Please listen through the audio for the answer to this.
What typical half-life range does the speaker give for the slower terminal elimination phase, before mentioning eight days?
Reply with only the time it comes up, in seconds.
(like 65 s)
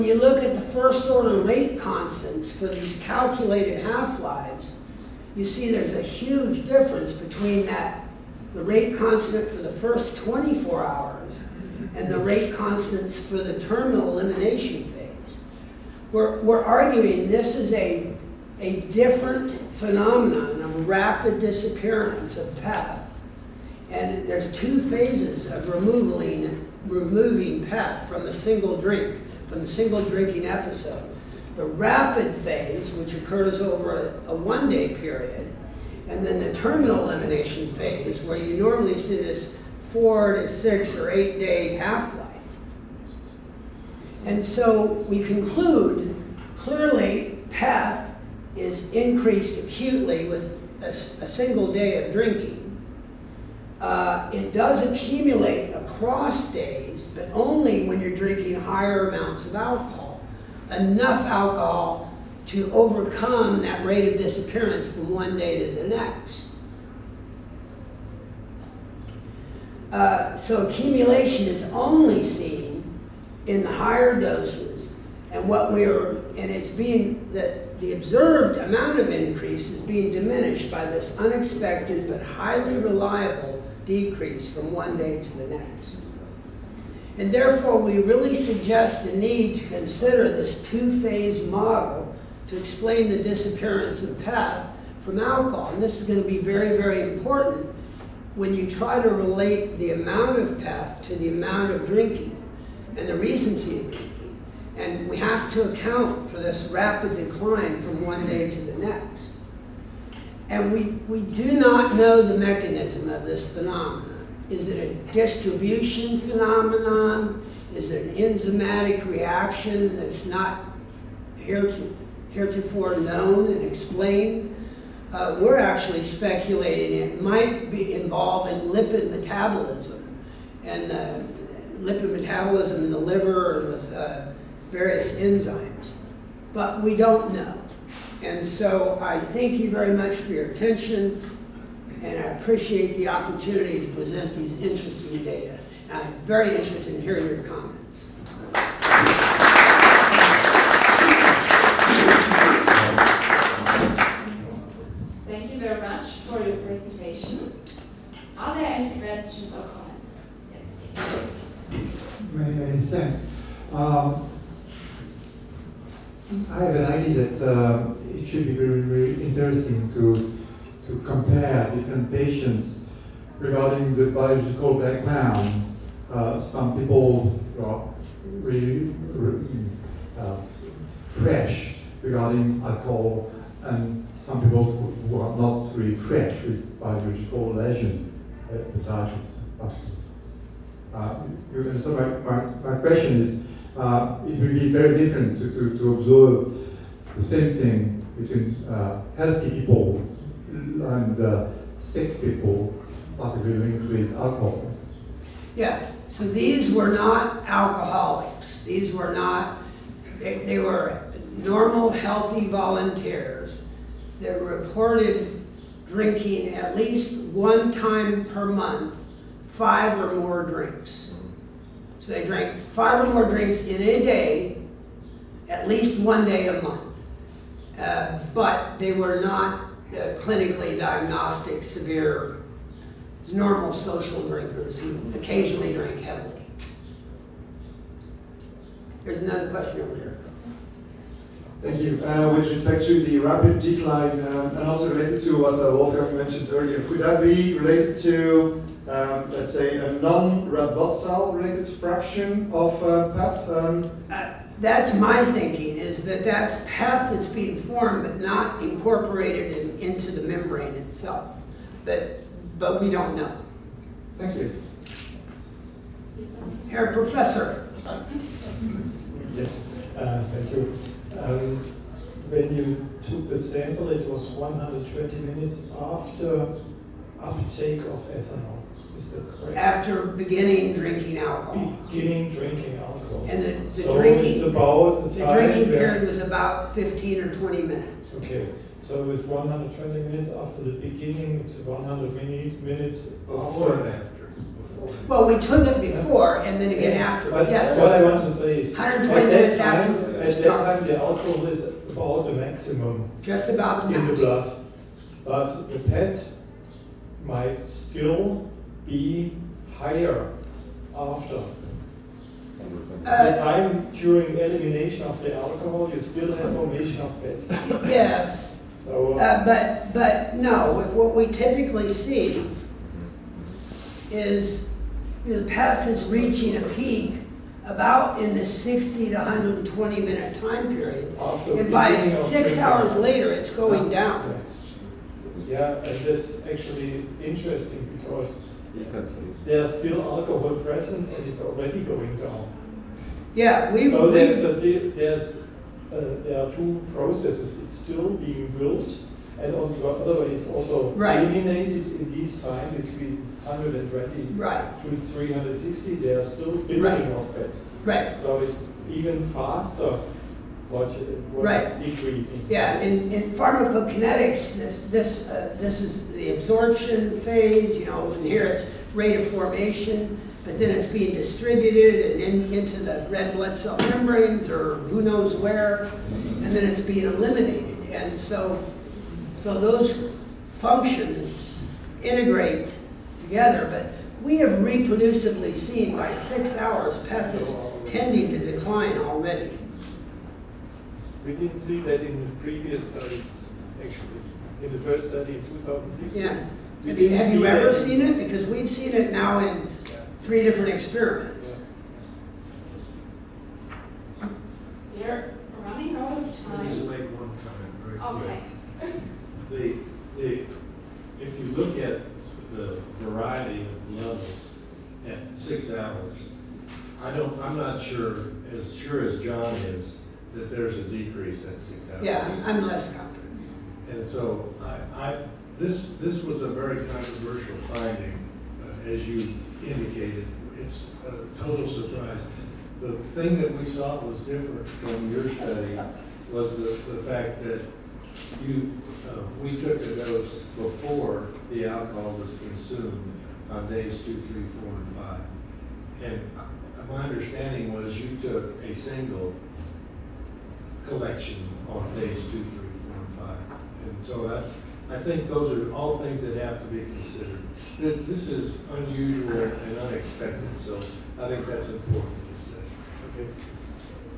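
39 s.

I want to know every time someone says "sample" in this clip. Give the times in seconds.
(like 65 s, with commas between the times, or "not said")
273 s.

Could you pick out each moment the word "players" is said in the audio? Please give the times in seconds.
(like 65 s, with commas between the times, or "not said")
not said.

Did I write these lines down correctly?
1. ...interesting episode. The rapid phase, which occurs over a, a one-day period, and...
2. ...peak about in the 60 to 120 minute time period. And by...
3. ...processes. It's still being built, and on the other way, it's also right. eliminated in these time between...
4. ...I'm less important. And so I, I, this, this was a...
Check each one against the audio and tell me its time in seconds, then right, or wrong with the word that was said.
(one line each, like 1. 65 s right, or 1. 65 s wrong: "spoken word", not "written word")
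1. 30 s wrong: "drinking", not "interesting"
2. 326 s right
3. 346 s right
4. 422 s wrong: "confident", not "important".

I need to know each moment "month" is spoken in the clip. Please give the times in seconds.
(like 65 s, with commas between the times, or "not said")
218 s, 226 s.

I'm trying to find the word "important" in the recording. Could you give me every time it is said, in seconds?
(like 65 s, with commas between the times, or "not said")
97 s, 461 s.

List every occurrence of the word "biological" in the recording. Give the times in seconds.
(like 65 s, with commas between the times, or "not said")
174 s, 186 s.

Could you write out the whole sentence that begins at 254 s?
Uh, that's my thinking, is that that's PEth that's being formed but not incorporated in into the membrane itself.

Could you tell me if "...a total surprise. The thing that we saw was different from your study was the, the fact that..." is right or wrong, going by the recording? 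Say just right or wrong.
right.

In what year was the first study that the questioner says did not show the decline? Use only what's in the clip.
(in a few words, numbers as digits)
2016.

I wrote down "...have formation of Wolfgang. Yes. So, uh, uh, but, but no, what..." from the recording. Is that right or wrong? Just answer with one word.
wrong.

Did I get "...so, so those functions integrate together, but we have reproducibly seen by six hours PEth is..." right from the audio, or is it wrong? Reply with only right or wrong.
right.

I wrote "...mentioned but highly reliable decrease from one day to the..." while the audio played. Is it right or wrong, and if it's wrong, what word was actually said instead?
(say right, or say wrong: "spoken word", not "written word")
wrong: "unexpected", not "mentioned".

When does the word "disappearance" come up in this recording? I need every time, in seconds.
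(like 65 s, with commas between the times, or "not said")
21 s, 64 s, 93 s.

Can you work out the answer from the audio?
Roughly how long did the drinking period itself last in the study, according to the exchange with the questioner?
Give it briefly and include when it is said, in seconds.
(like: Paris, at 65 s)
15 or 20 minutes, at 286 s.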